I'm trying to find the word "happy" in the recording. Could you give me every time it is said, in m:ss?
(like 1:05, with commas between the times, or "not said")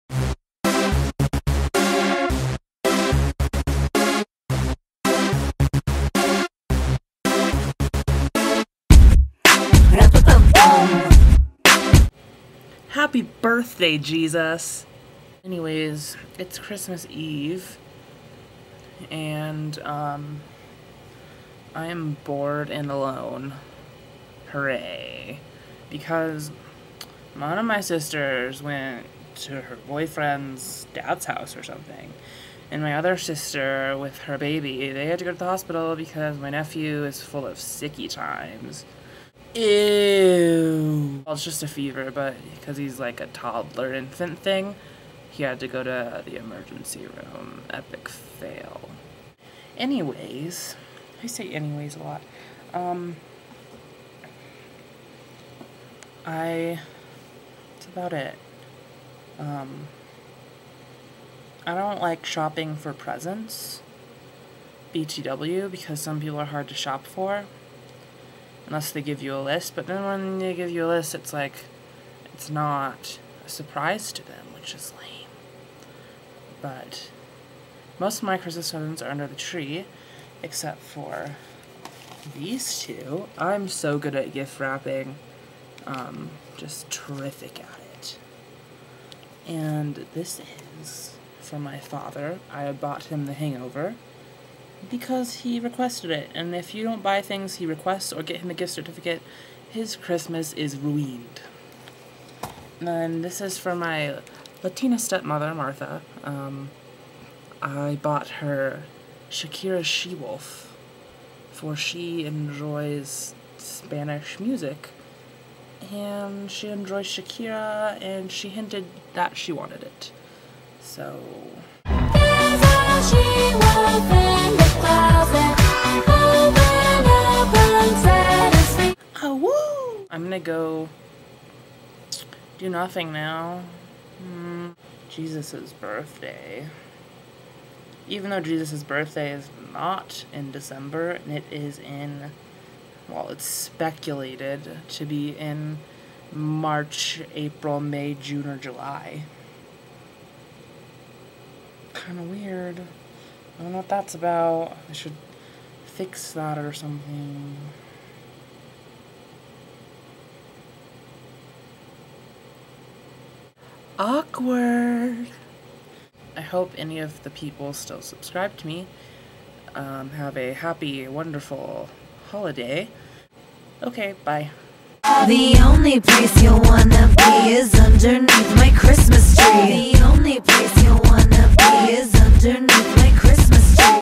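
0:13, 2:50.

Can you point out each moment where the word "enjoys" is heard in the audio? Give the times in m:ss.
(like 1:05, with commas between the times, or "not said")
1:52, 1:56.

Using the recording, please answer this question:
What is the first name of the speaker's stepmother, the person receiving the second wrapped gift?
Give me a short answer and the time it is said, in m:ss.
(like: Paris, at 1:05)
Martha, at 1:45.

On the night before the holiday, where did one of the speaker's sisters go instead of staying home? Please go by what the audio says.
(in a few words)
Her boyfriend's dad's house.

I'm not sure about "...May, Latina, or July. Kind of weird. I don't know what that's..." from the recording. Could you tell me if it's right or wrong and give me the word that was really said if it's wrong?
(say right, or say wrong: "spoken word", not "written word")
wrong: "June", not "Latina".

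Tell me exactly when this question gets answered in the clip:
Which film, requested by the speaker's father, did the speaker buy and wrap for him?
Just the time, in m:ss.
1:33.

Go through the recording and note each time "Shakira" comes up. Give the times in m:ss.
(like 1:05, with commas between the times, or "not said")
1:49, 1:57.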